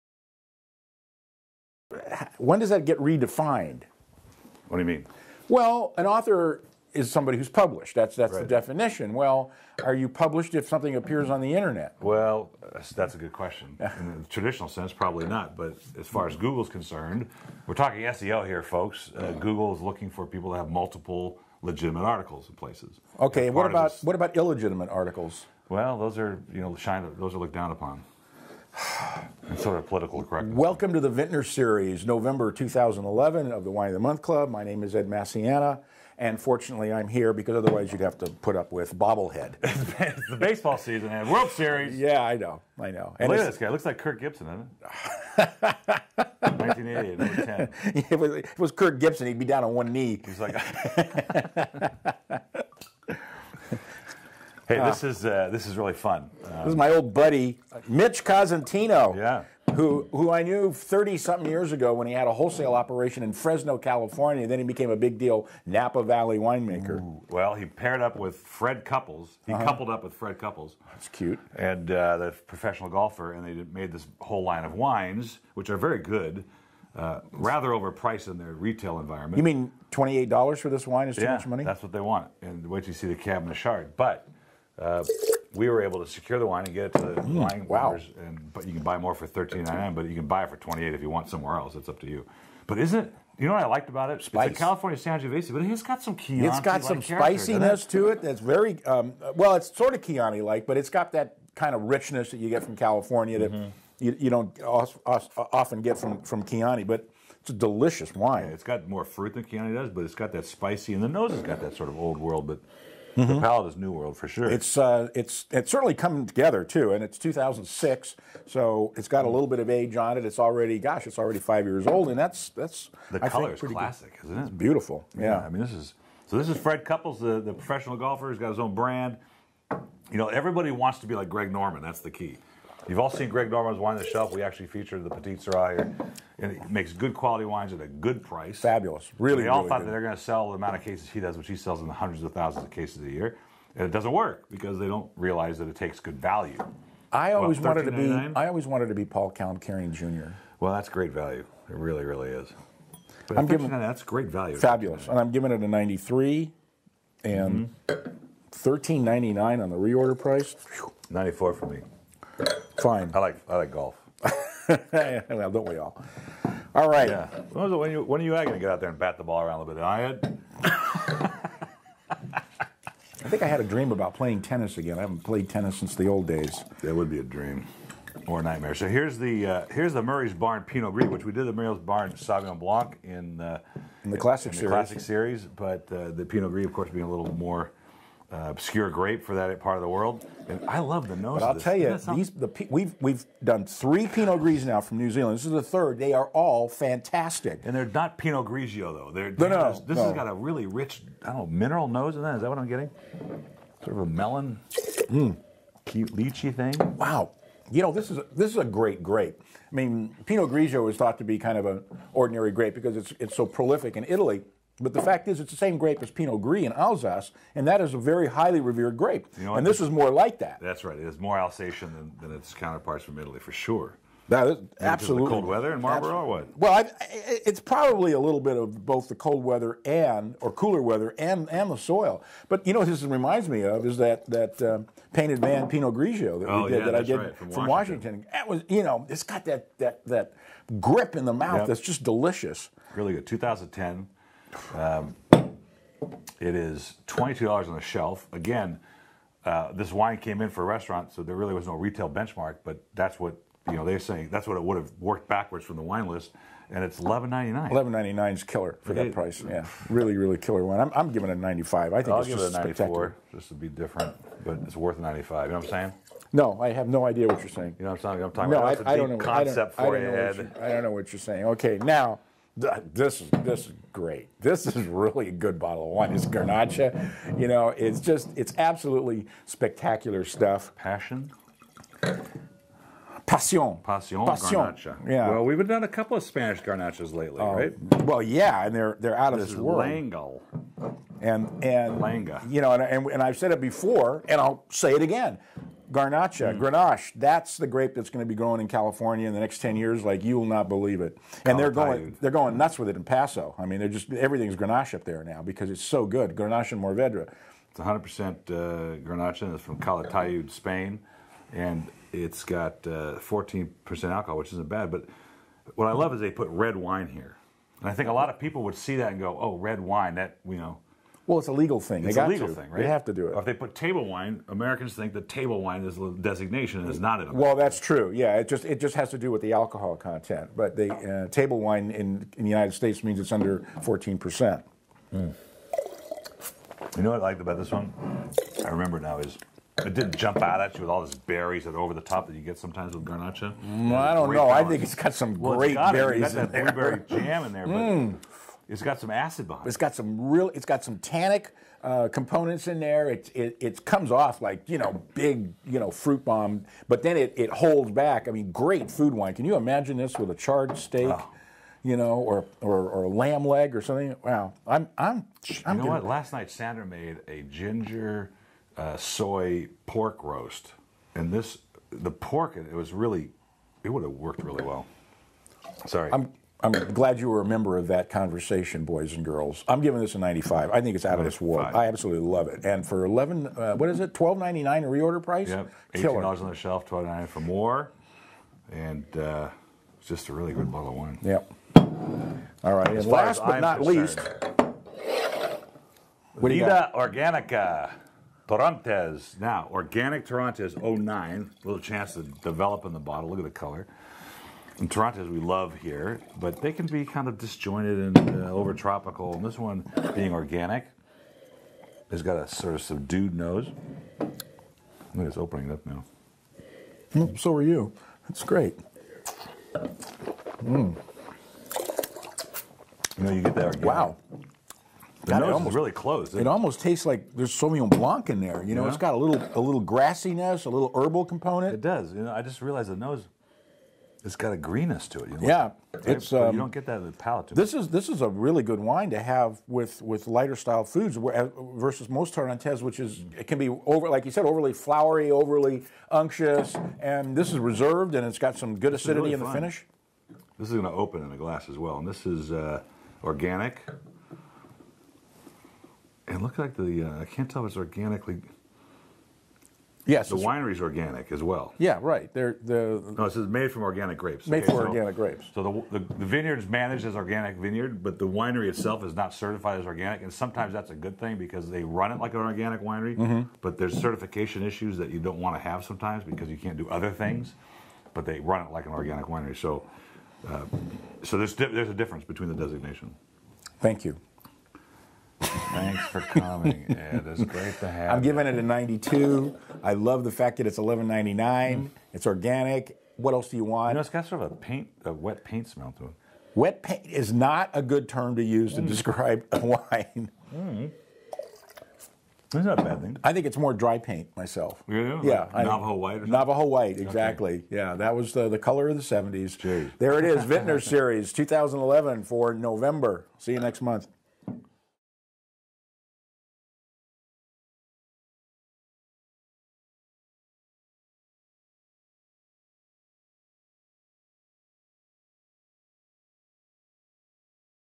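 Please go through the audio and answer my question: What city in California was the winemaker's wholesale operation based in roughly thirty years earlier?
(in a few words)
Fresno.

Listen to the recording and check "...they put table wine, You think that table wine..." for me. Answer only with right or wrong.
wrong.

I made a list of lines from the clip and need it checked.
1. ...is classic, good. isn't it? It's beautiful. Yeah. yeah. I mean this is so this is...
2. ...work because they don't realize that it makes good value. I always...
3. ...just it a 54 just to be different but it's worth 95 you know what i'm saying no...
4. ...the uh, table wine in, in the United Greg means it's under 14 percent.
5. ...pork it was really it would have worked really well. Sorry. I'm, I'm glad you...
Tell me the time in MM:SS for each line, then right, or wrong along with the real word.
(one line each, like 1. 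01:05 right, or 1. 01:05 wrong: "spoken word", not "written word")
1. 02:03 right
2. 02:24 wrong: "takes", not "makes"
3. 04:22 wrong: "94", not "54"
4. 05:30 wrong: "States", not "Greg"
5. 06:12 right.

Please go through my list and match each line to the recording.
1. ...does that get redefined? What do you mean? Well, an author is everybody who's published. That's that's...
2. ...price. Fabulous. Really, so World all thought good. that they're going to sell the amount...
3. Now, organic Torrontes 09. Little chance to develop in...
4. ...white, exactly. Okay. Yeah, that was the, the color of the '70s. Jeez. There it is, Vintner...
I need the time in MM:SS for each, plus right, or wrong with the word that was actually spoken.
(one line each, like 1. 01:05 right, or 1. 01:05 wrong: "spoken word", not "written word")
1. 00:02 wrong: "somebody", not "everybody"
2. 02:18 wrong: "They", not "World"
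3. 06:39 right
4. 08:26 right.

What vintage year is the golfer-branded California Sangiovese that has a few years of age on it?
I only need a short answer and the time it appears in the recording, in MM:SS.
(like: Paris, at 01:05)
2006, at 01:57.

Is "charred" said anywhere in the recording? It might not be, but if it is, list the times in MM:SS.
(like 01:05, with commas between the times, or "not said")
06:00.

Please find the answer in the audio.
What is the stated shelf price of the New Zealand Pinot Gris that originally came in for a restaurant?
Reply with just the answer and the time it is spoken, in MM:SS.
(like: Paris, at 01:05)
$22, at 04:07.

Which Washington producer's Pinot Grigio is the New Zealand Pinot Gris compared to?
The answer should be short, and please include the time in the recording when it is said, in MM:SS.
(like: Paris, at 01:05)
Painted Man, at 03:55.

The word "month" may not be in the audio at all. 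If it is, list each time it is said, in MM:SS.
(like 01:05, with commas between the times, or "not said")
00:33, 08:33.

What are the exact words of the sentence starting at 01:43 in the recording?
you, you, don't often get from from Chianti.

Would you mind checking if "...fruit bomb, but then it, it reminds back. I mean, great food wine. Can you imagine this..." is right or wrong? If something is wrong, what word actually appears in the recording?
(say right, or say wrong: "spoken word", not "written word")
wrong: "holds", not "reminds".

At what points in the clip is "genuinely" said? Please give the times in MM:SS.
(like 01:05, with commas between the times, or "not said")
not said.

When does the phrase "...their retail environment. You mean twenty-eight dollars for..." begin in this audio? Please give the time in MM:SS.
01:18.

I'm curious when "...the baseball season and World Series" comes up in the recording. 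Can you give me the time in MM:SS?
00:40.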